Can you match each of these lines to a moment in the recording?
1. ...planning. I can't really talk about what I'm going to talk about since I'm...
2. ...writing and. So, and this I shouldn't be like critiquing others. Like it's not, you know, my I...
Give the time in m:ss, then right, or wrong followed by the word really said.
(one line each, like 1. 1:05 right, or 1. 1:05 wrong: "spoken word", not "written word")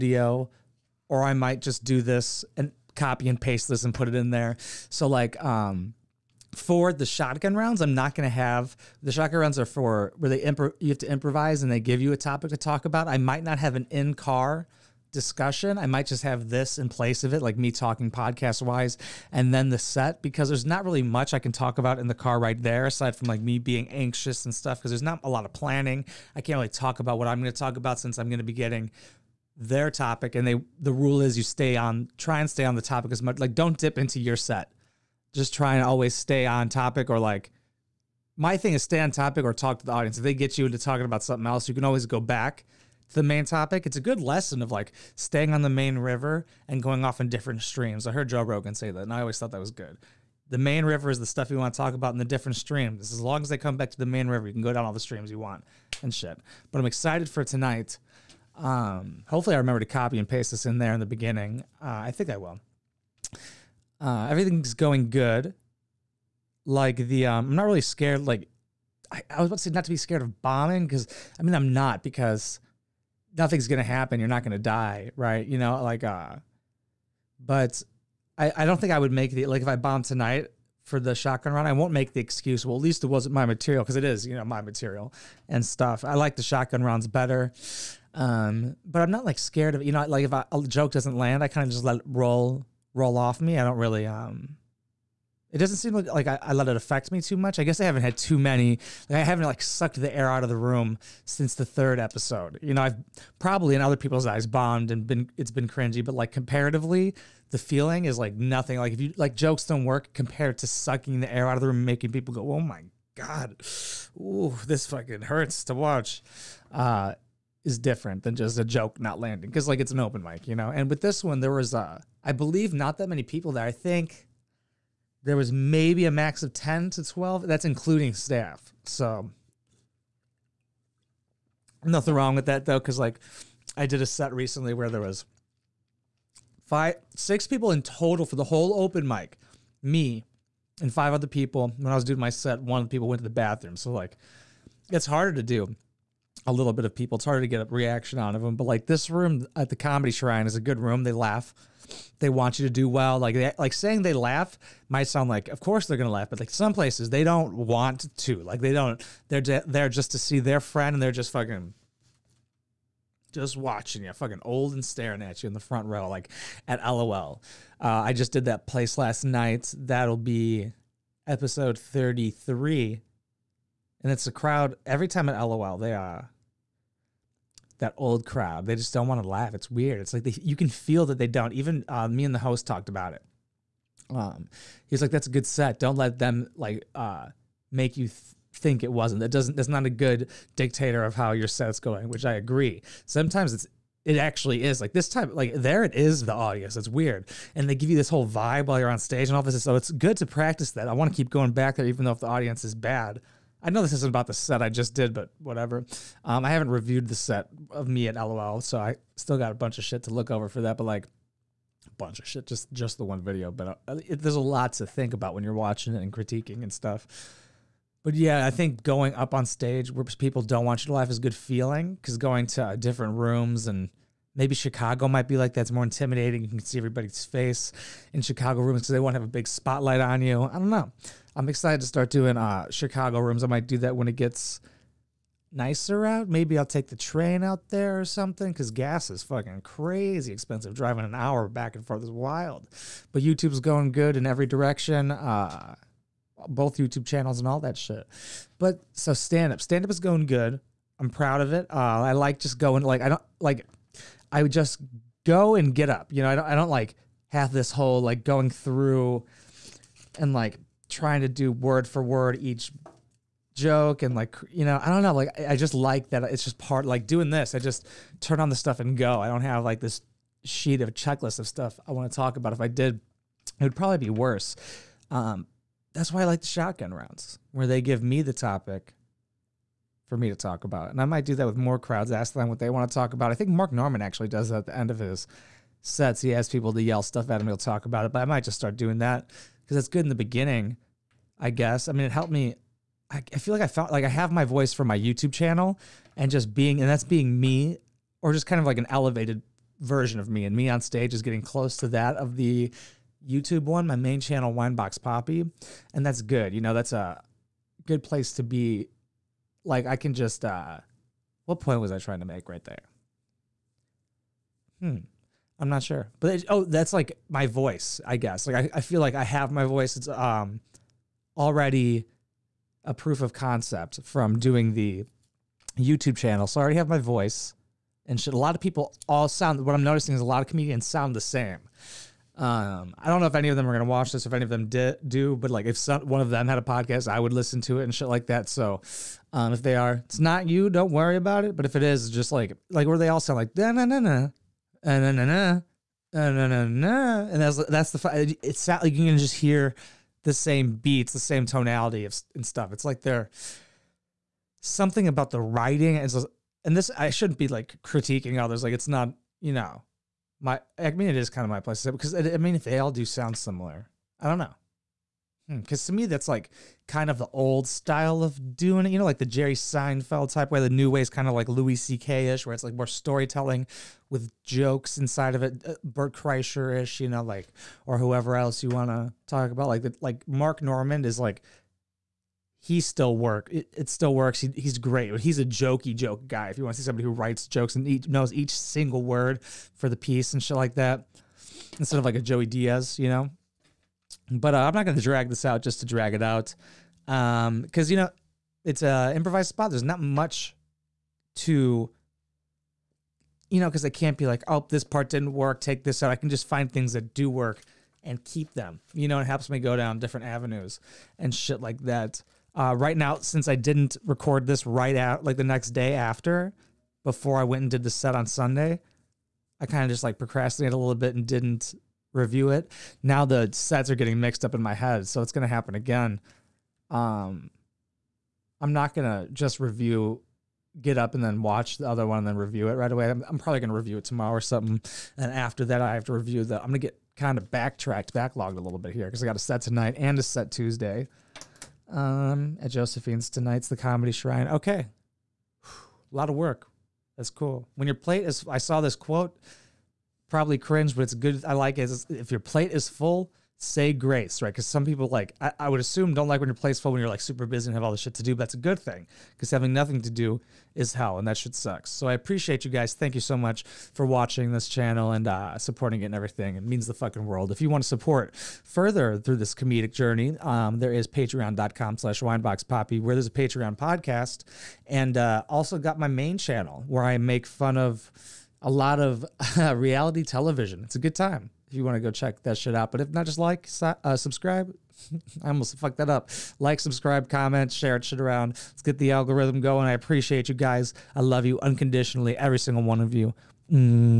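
1. 0:25 right
2. 5:55 right.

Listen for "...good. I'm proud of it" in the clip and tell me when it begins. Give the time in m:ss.
4:10.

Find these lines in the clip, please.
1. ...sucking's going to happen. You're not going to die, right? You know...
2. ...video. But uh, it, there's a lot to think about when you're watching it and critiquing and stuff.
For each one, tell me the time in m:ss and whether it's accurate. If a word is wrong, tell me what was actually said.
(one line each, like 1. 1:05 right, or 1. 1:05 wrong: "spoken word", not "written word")
1. 1:13 wrong: "nothing", not "sucking"
2. 3:33 right.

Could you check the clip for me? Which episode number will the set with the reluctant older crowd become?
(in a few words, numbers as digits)
33.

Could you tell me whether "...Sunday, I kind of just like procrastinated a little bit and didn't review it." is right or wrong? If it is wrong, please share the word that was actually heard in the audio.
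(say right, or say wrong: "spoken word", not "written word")
right.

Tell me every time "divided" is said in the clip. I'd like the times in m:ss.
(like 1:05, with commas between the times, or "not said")
not said.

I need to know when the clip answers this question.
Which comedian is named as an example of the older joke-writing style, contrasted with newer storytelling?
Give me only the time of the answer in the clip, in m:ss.
6:09.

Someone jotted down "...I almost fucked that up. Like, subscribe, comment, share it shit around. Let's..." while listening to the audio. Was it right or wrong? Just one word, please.
right.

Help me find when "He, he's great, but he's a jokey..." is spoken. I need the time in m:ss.
6:24.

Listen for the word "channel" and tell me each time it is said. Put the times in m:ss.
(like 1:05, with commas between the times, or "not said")
4:07, 4:55, 5:04, 5:26, 7:44, 7:56.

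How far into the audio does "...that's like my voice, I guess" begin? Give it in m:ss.
5:16.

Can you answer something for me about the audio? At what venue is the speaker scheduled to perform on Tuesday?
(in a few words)
Josephine's.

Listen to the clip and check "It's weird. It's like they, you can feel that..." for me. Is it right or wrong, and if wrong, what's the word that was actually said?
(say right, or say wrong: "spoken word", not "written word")
right.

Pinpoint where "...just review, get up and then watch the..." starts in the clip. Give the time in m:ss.
7:09.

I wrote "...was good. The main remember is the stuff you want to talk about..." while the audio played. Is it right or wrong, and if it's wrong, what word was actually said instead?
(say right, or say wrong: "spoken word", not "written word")
wrong: "river", not "remember".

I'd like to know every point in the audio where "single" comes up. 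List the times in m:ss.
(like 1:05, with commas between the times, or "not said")
6:28, 8:12.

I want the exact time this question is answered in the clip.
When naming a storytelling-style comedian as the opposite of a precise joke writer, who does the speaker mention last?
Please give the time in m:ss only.
6:32.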